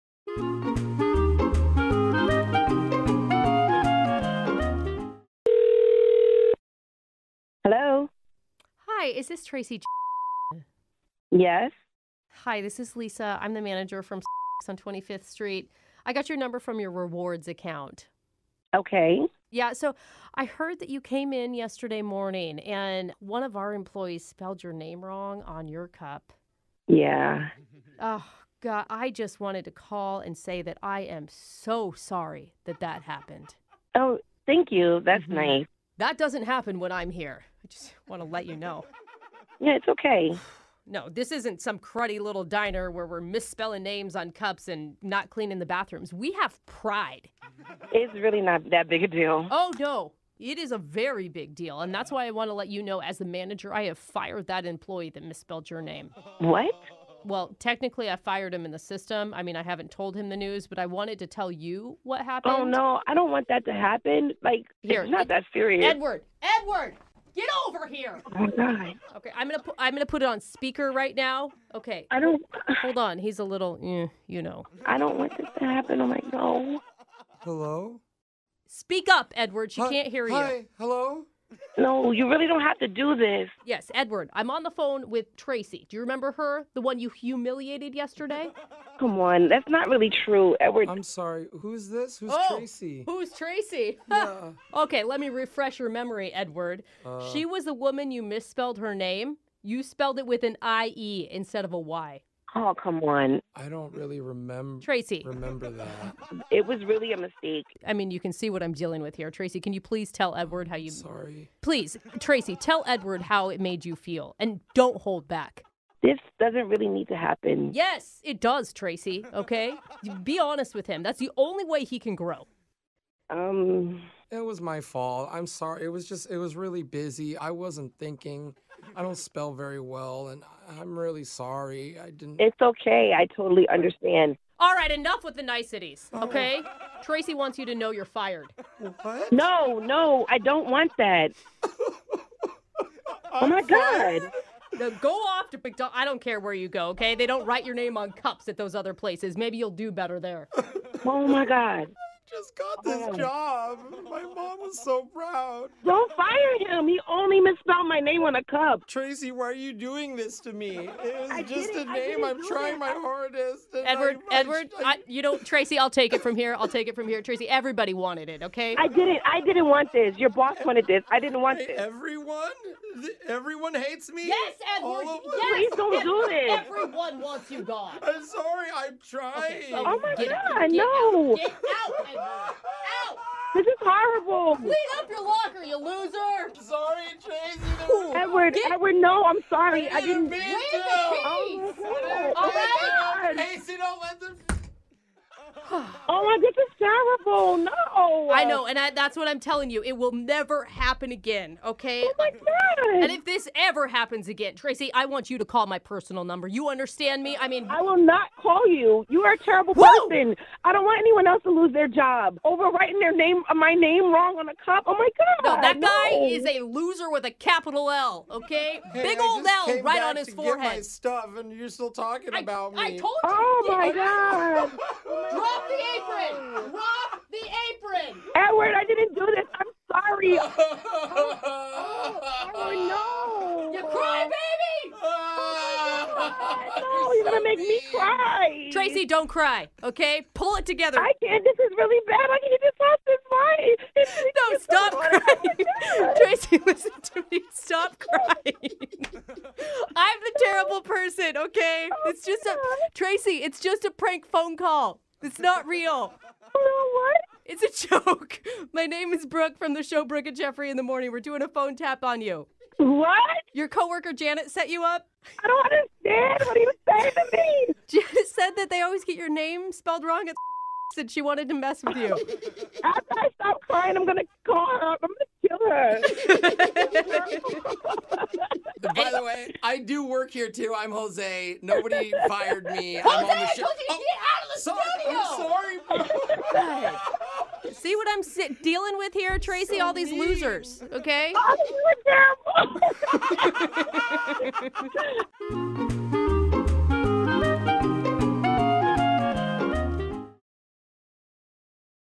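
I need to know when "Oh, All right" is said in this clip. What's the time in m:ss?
3:10.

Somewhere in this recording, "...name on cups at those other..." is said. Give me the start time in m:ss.
2:27.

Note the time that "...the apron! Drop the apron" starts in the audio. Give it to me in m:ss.
3:45.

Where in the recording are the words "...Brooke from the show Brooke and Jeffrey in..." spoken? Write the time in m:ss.
4:19.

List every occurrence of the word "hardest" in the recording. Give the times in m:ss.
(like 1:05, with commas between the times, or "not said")
2:42.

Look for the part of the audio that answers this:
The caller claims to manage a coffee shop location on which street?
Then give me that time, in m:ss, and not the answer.
0:14.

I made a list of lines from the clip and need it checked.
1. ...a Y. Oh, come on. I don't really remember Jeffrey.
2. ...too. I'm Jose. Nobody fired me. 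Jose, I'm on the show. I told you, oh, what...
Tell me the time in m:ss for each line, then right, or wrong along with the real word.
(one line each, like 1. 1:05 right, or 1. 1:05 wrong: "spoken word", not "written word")
1. 1:41 wrong: "Tracy", not "Jeffrey"
2. 4:40 right.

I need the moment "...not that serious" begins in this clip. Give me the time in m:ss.
1:05.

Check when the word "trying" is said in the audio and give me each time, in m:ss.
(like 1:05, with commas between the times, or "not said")
2:42, 2:59.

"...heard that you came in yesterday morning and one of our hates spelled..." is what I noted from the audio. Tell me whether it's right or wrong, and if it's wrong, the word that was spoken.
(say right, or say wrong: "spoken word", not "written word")
wrong: "employees", not "hates".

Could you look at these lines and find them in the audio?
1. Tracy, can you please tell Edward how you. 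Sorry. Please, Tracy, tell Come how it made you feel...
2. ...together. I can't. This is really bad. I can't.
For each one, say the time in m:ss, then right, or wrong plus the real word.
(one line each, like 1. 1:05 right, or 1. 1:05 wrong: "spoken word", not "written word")
1. 1:49 wrong: "Edward", not "Come"
2. 4:00 right.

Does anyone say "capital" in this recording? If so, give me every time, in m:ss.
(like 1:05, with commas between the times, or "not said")
3:37.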